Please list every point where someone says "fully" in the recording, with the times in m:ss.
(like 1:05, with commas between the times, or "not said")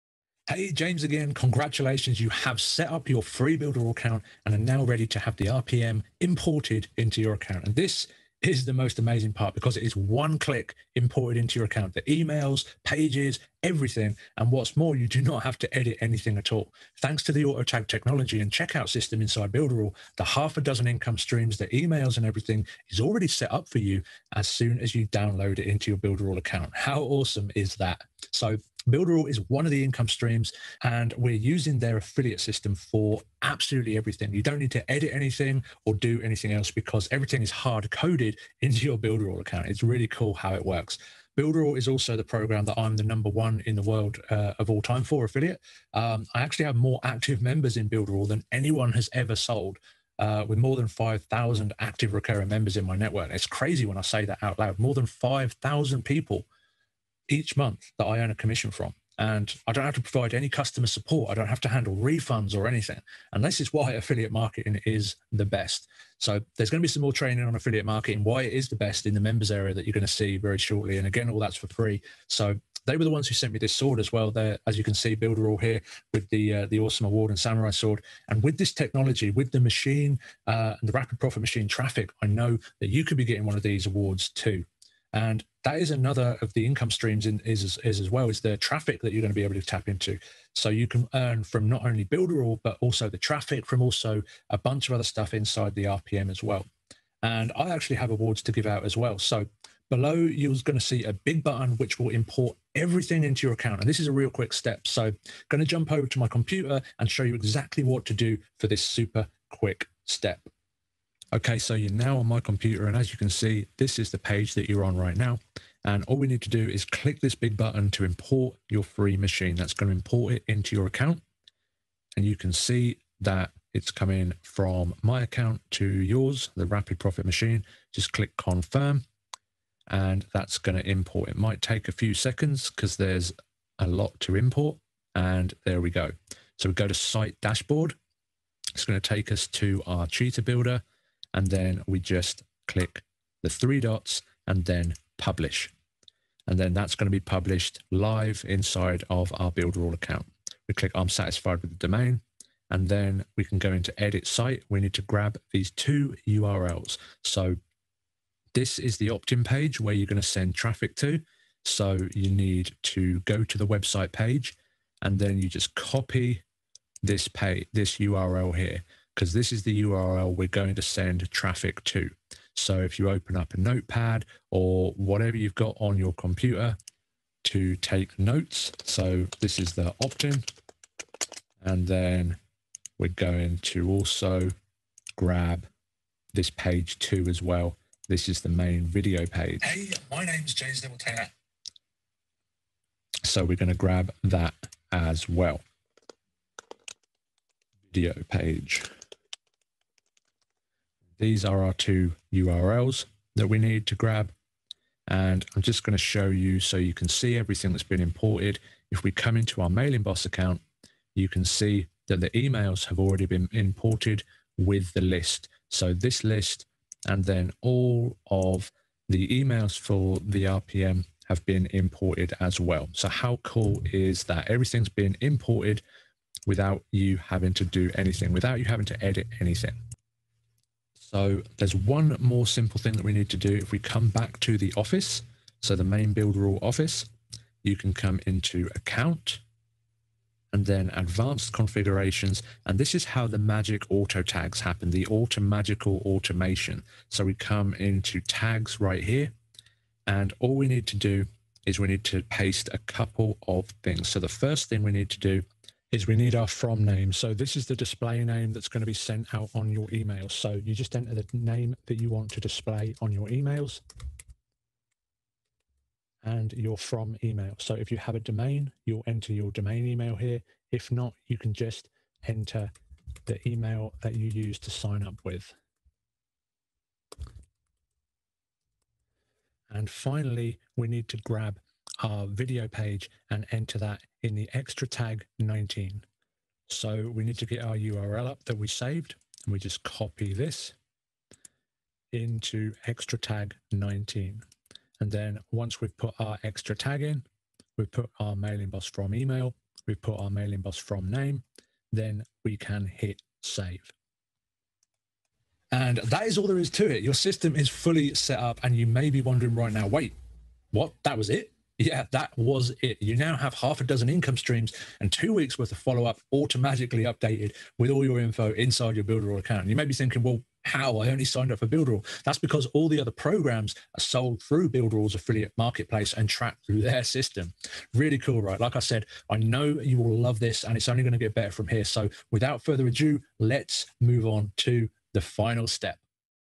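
5:07.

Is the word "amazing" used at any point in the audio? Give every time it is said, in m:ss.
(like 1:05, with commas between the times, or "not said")
0:08.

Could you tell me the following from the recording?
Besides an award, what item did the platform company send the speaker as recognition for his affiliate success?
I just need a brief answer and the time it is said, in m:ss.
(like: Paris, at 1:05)
samurai sword, at 1:17.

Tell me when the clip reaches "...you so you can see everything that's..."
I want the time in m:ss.
3:26.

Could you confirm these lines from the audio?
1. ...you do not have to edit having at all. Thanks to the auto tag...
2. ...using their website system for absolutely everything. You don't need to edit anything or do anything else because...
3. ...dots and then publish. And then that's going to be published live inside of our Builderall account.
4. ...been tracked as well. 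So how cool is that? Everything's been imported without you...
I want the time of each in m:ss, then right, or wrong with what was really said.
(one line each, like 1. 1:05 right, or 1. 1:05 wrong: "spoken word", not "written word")
1. 0:14 wrong: "anything", not "having"
2. 0:31 wrong: "affiliate", not "website"
3. 2:23 right
4. 3:41 wrong: "imported", not "tracked".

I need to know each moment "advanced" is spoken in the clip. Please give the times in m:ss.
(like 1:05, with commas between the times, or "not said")
4:00.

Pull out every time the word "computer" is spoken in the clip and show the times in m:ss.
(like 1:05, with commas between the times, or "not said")
1:46, 1:52, 2:56.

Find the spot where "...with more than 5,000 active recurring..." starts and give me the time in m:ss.
0:50.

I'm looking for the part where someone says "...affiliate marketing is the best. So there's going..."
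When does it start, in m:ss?
1:03.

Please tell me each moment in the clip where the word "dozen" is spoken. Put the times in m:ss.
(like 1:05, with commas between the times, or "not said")
0:20, 5:13.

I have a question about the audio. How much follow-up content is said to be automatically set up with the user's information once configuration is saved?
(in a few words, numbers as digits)
two weeks.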